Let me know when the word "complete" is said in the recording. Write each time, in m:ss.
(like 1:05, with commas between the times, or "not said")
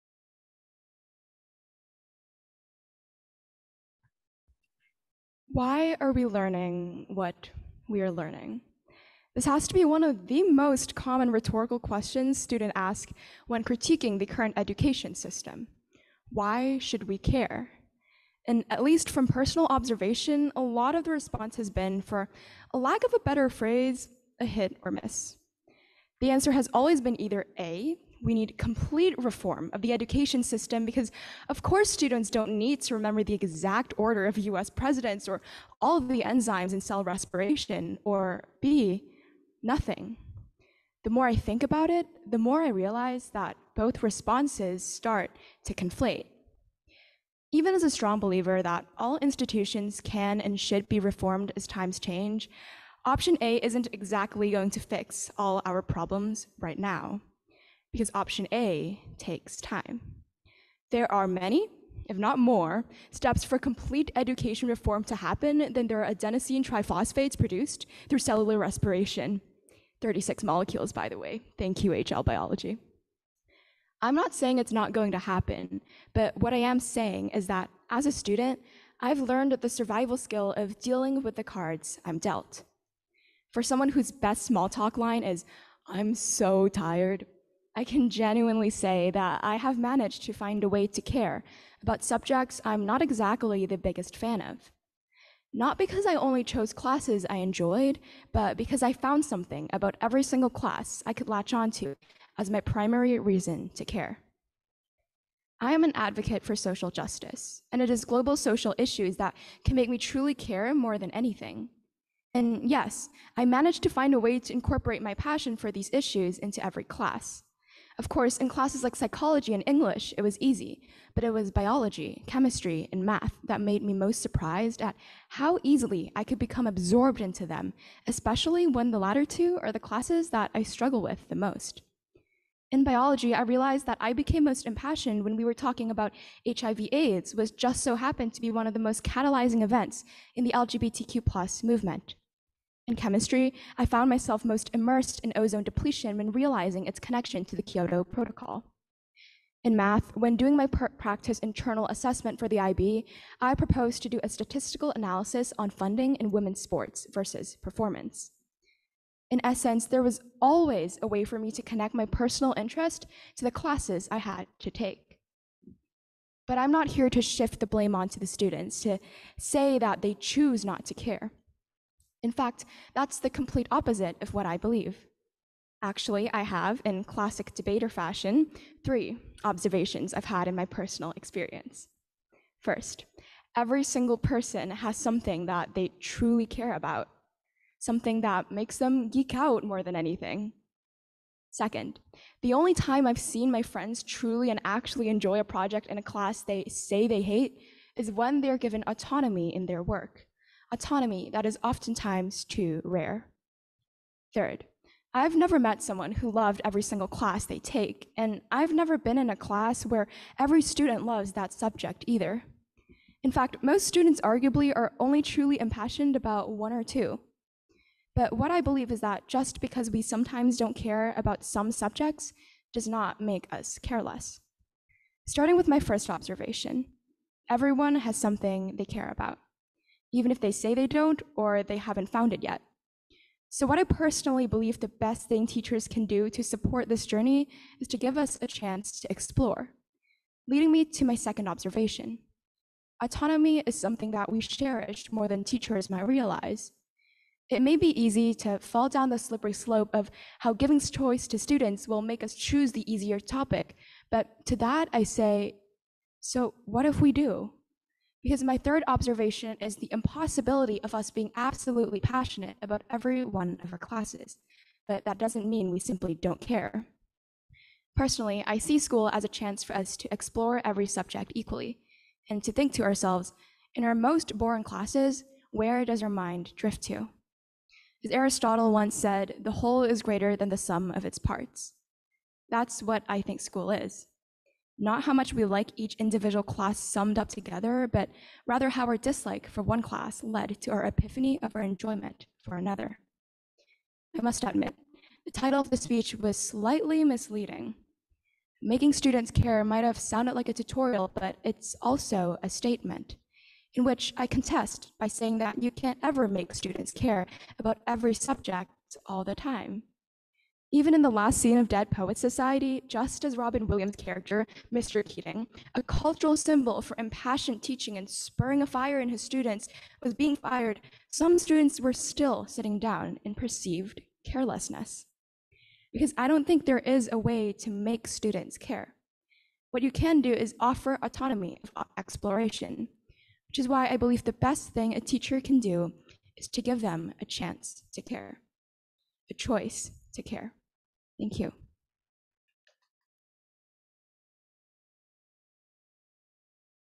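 0:28, 1:03, 2:53.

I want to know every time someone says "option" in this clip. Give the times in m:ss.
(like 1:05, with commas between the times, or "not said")
0:53, 0:58.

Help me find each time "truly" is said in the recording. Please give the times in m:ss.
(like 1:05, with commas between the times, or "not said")
1:49, 3:05, 3:14, 3:35.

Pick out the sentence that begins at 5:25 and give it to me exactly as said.
Because I don't think there is a way to make students care.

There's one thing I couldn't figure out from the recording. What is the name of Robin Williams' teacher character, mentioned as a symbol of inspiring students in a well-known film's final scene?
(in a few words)
Mr. Keating.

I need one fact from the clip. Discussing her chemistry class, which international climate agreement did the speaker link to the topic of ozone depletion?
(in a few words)
Kyoto Protocol.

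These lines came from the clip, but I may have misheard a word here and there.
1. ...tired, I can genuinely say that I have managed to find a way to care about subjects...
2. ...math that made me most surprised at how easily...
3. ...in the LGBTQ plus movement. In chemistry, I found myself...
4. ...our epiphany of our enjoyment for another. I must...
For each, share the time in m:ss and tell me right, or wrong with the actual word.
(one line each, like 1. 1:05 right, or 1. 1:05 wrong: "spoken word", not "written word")
1. 1:26 right
2. 2:03 right
3. 2:20 right
4. 4:50 right.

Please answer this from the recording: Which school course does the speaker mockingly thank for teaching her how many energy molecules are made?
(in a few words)
HL Biology.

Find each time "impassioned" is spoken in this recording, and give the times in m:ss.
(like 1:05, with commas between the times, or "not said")
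2:14, 3:35, 5:16.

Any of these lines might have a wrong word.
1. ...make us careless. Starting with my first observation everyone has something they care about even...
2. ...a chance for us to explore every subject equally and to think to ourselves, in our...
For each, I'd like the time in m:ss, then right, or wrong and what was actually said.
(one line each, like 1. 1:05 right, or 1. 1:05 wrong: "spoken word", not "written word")
1. 3:43 right
2. 4:29 right.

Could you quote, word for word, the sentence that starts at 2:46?
But I'm not here to shift the blame onto the students, to say that they choose not to care.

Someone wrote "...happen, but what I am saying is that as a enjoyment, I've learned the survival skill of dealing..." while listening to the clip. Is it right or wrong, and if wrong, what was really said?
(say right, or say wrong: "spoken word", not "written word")
wrong: "student", not "enjoyment".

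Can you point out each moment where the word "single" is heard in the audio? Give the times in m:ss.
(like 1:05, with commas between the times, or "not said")
1:40, 3:03, 3:26.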